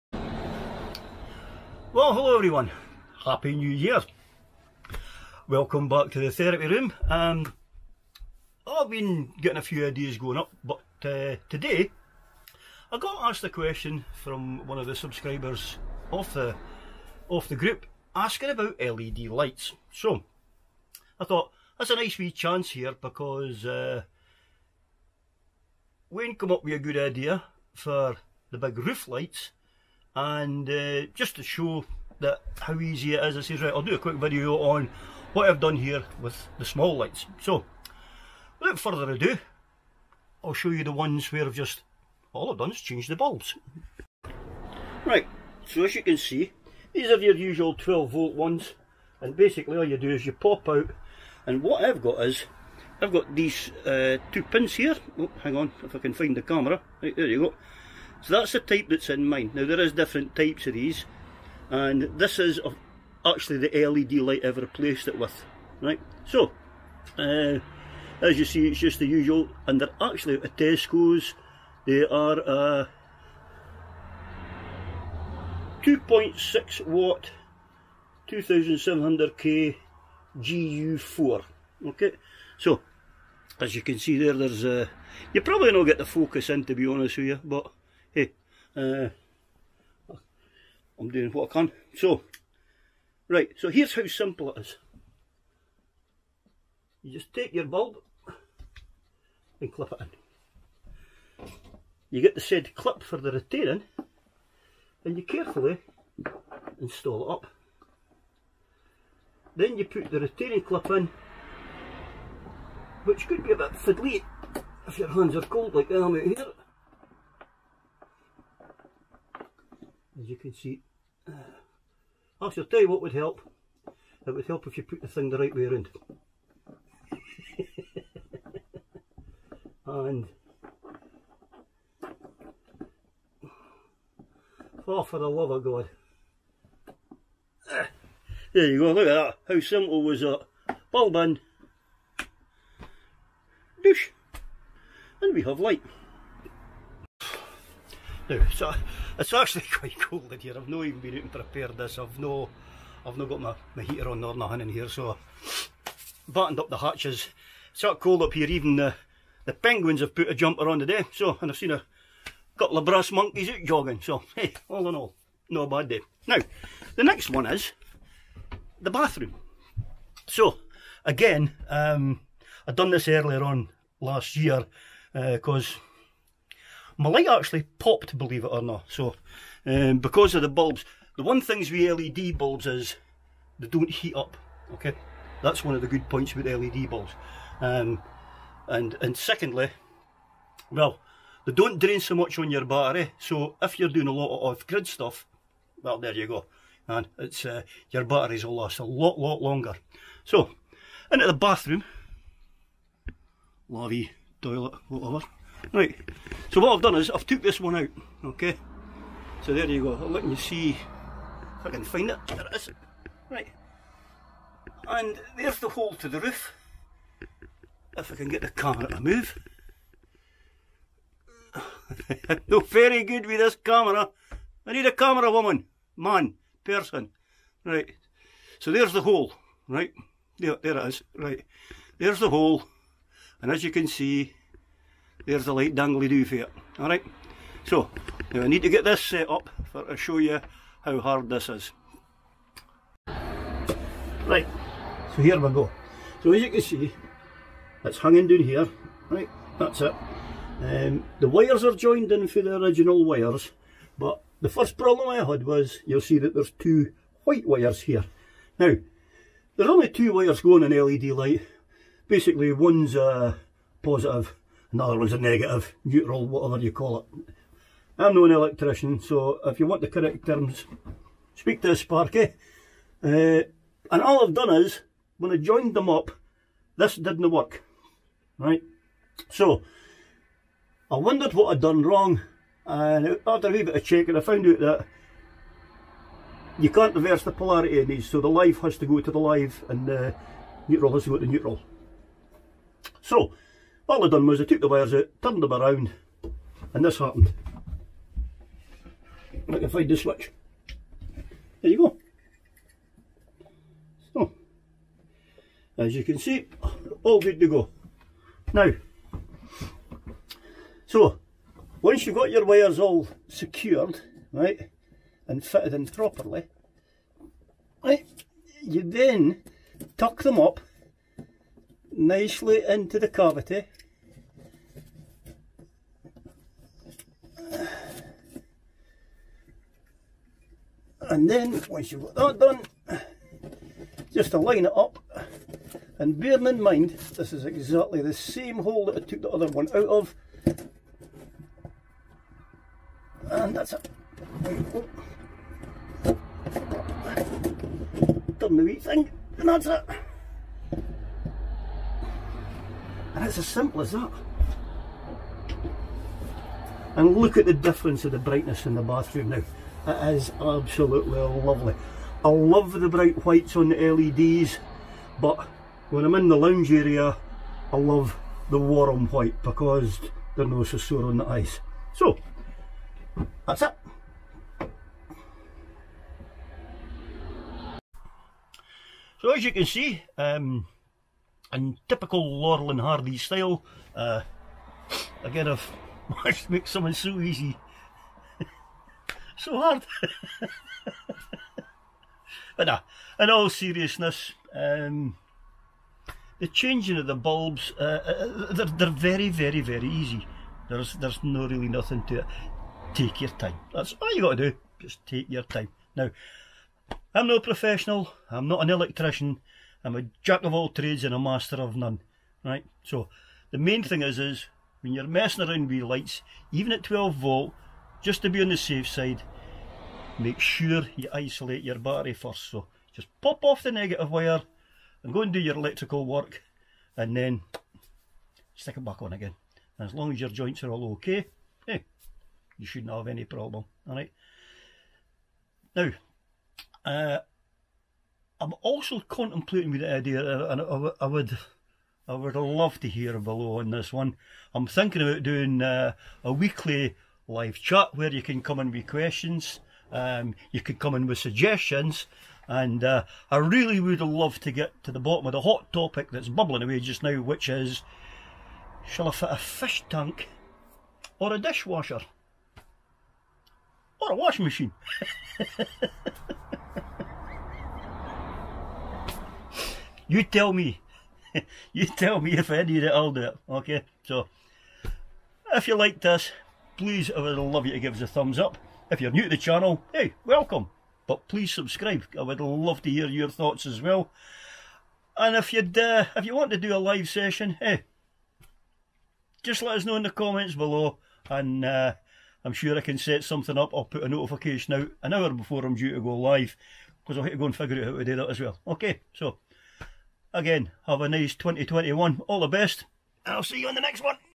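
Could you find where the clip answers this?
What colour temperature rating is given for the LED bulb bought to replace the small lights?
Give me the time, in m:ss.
1:18.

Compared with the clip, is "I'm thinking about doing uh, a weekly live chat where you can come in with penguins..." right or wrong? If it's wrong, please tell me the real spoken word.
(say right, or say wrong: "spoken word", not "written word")
wrong: "questions", not "penguins".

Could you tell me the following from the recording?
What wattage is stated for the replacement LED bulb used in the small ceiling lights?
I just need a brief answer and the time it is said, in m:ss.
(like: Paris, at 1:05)
2.6 watt, at 1:15.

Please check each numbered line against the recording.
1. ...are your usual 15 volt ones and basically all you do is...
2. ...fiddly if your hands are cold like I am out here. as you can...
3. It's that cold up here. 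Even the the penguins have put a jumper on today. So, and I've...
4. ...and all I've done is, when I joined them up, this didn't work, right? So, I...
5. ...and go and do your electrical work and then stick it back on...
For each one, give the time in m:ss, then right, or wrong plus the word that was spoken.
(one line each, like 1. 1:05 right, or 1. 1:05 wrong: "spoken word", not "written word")
1. 0:47 wrong: "12", not "15"
2. 1:53 right
3. 2:37 right
4. 4:33 right
5. 7:05 right.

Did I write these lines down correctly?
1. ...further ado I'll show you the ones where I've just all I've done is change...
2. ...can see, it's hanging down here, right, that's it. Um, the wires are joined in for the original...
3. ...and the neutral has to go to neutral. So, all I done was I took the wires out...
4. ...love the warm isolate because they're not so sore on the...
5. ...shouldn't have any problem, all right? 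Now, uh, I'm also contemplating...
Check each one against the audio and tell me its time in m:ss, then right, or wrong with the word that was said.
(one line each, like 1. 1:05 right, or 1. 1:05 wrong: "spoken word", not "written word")
1. 0:38 right
2. 4:06 right
3. 4:49 right
4. 6:07 wrong: "white", not "isolate"
5. 7:12 right.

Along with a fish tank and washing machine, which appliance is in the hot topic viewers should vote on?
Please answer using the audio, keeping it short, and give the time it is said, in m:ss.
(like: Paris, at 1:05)
dishwasher, at 7:41.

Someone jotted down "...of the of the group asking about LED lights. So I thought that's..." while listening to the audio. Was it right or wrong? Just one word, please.
right.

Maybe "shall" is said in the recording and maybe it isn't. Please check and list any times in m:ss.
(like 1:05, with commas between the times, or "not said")
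2:02, 7:38.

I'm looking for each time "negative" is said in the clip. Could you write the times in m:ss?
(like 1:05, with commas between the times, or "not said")
4:25, 7:03.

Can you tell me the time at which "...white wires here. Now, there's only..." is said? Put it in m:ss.
4:17.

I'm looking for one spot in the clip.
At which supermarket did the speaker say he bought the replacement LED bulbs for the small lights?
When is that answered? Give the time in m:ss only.
1:10.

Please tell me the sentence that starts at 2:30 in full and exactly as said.
I've not even been out and prepared this.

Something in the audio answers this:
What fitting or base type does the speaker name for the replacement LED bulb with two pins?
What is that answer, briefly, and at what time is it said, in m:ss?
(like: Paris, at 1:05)
GU4, at 1:20.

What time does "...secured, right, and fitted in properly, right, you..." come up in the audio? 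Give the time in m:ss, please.
5:13.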